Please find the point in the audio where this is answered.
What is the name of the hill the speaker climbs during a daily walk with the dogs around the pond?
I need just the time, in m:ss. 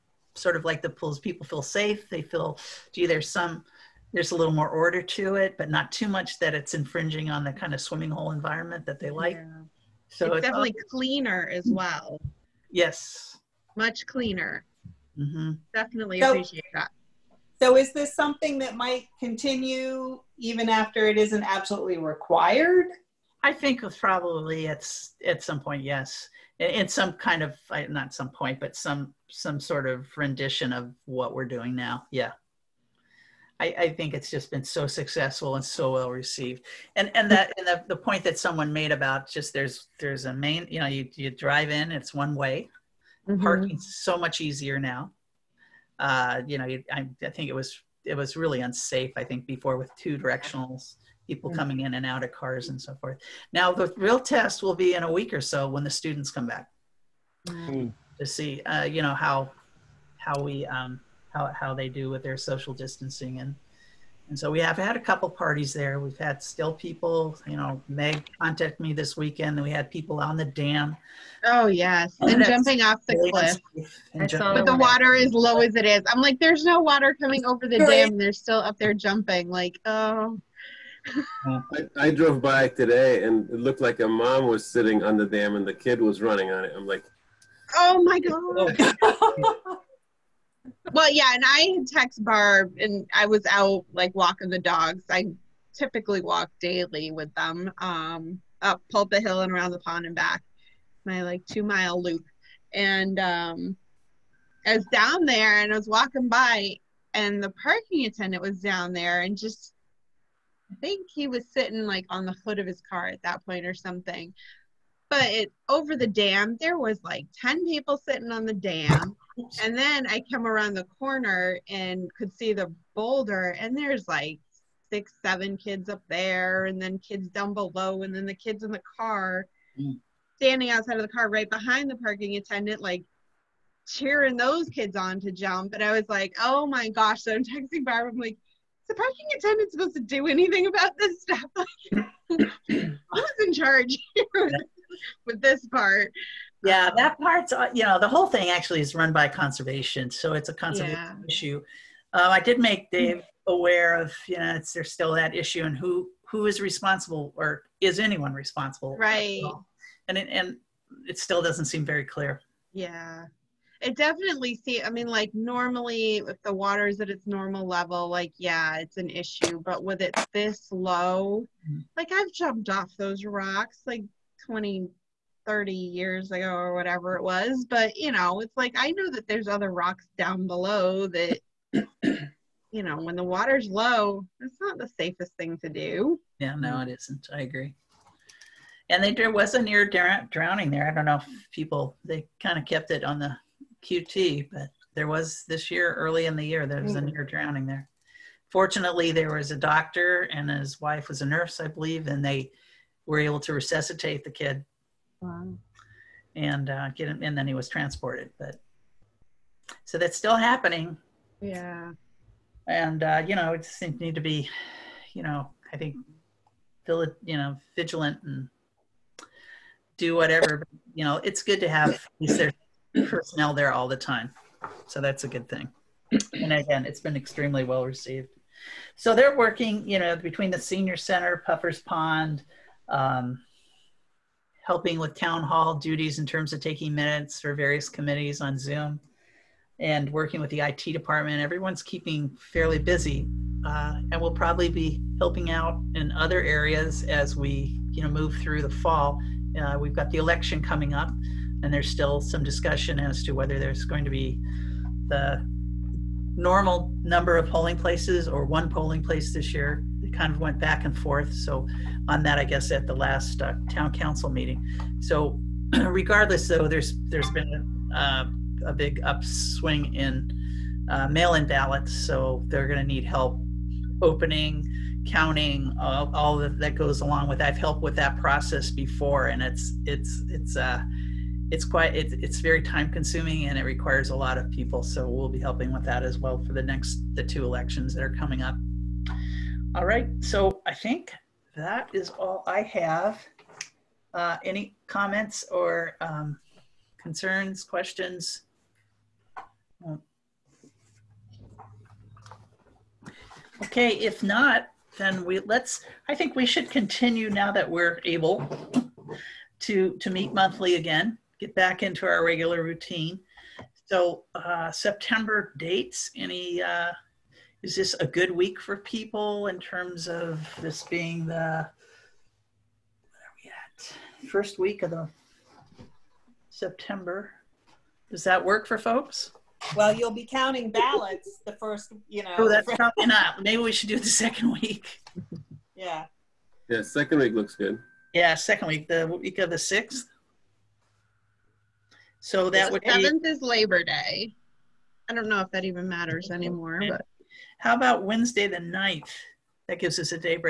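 1:38.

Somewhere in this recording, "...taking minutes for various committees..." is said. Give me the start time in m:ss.
3:56.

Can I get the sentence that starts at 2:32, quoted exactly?
Dave aware of, you know, it's, there's still that issue and who, who is responsible or is anyone responsible?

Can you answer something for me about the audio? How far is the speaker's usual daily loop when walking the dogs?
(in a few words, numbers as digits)
2 miles.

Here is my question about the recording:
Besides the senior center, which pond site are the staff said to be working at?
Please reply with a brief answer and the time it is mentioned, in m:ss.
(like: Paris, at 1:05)
Puffer's Pond, at 3:51.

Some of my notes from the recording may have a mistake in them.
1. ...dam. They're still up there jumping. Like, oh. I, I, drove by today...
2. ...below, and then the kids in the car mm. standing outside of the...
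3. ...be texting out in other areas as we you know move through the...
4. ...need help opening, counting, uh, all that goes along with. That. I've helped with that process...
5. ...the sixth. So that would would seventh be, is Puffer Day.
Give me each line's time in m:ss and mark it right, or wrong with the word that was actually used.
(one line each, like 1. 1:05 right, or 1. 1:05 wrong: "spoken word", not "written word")
1. 1:17 right
2. 2:07 right
3. 4:04 wrong: "helping", not "texting"
4. 4:32 right
5. 5:39 wrong: "Labor", not "Puffer".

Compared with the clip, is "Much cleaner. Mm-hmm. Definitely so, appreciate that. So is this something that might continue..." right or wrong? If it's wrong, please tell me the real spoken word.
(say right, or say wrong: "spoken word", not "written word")
right.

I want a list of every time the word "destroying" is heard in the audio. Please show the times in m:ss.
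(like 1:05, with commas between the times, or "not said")
not said.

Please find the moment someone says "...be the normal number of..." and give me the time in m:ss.
4:14.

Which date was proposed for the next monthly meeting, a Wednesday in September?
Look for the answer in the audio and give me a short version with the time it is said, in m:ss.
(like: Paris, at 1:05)
September 9, at 5:48.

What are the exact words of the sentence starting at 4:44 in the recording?
So we'll be helping with that as well for the next the two elections that are coming up.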